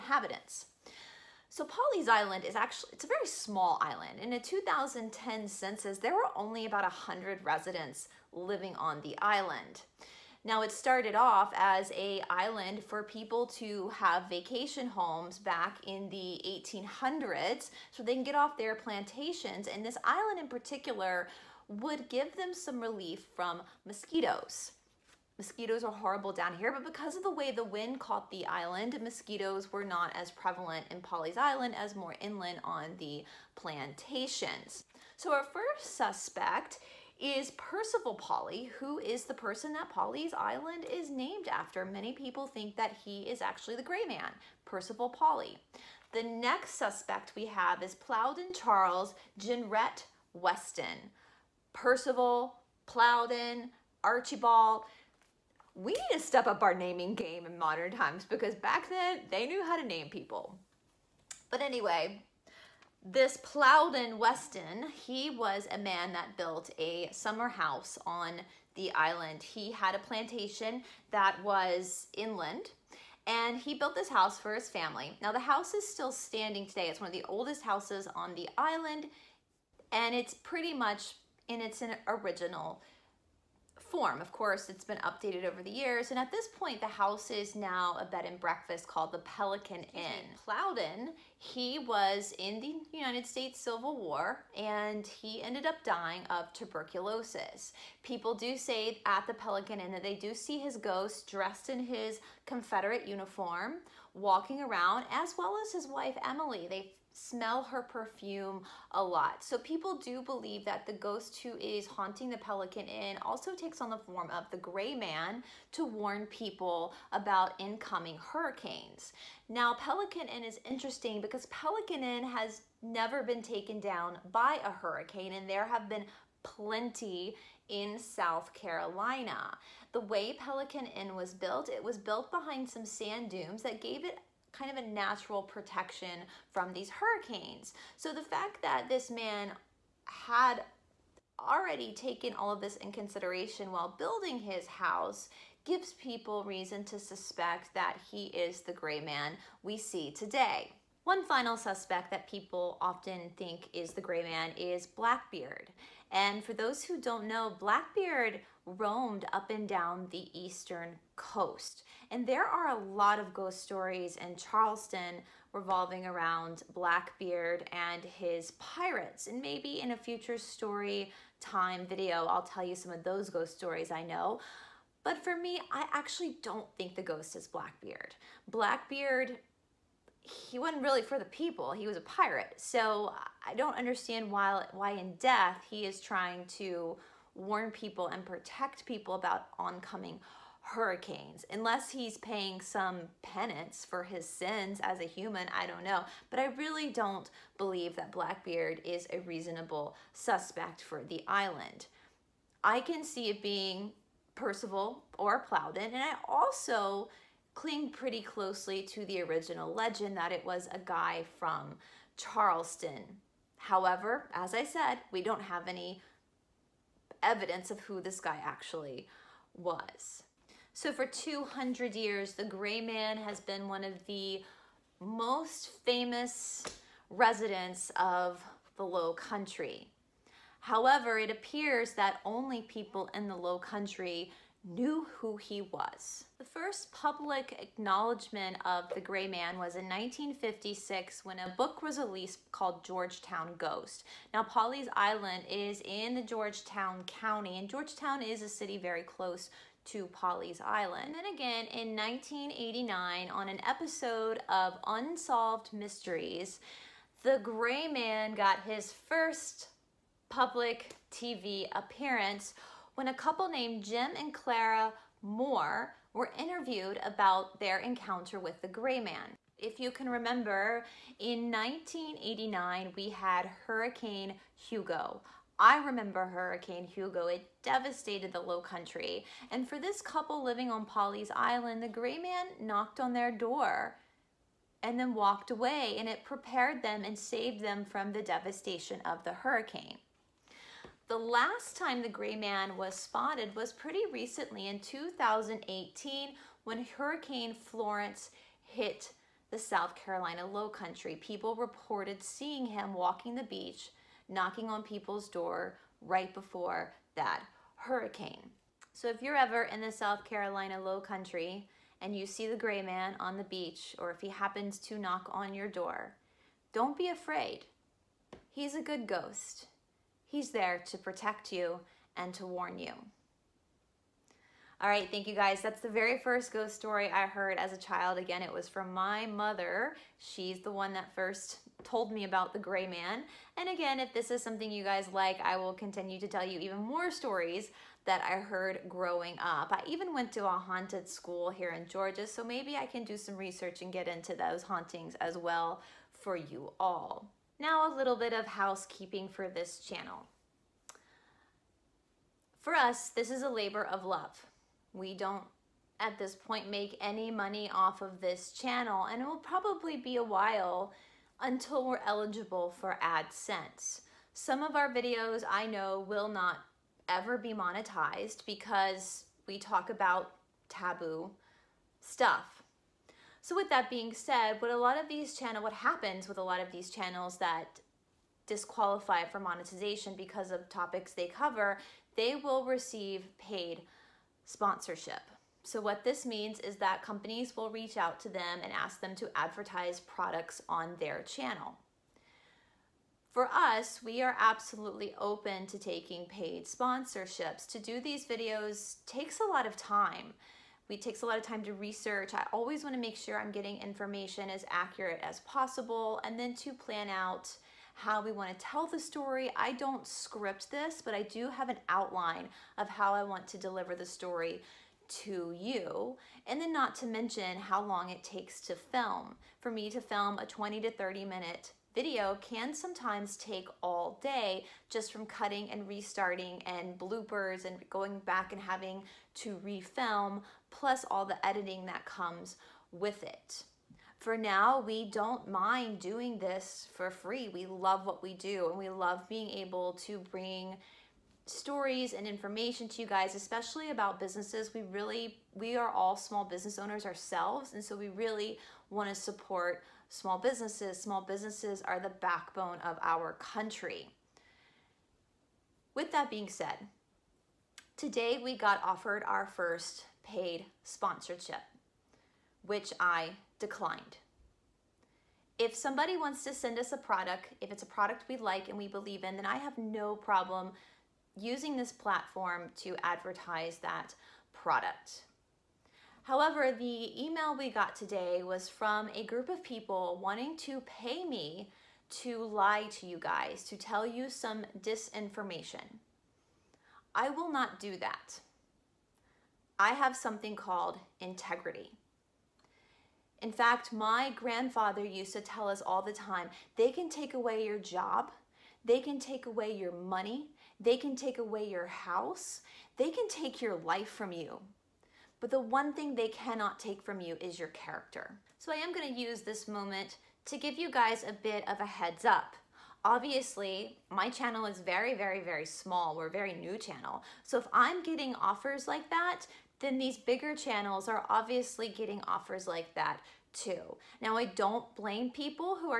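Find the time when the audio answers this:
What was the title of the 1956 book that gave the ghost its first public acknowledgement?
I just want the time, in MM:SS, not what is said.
04:02.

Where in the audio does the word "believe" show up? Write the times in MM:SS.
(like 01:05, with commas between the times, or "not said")
01:50, 03:17, 07:48.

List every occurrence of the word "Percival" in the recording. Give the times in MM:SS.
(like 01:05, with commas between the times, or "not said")
00:37, 00:44, 00:51, 03:24.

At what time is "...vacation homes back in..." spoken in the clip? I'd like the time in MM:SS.
00:14.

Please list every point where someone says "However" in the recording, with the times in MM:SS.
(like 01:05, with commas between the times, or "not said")
03:33, 03:50, 07:56.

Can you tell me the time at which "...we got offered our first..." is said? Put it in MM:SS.
07:38.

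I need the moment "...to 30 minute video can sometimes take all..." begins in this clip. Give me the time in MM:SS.
07:00.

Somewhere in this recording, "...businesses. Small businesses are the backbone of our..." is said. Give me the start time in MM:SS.
07:30.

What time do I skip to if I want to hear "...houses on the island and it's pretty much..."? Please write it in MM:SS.
01:17.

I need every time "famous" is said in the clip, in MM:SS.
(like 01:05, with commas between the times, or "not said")
03:45.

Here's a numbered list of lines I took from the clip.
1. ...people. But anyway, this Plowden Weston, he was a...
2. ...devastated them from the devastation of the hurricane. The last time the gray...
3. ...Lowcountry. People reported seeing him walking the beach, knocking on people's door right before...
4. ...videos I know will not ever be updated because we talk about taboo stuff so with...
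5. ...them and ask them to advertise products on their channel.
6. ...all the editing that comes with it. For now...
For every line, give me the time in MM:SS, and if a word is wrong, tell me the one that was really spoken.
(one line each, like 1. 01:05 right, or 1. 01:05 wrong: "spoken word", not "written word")
1. 01:00 right
2. 04:47 wrong: "saved", not "devastated"
3. 05:00 right
4. 06:04 wrong: "monetized", not "updated"
5. 06:28 right
6. 07:11 right.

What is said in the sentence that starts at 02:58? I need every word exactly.
Blackbeard, he wasn't really for the people, he was a pirate.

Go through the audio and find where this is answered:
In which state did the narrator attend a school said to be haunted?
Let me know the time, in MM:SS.
05:41.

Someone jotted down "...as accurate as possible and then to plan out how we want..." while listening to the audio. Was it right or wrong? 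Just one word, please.
right.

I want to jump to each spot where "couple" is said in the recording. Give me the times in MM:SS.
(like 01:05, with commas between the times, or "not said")
04:23, 04:40.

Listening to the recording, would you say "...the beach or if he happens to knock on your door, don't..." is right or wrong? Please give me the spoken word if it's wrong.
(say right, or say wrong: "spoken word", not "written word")
right.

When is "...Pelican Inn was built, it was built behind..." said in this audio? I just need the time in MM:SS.
02:10.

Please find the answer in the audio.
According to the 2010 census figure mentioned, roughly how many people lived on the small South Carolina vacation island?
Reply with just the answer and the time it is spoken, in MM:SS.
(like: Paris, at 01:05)
100, at 00:06.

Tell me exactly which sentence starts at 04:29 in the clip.
If you can remember, in 1989, we had Hurricane Hugo.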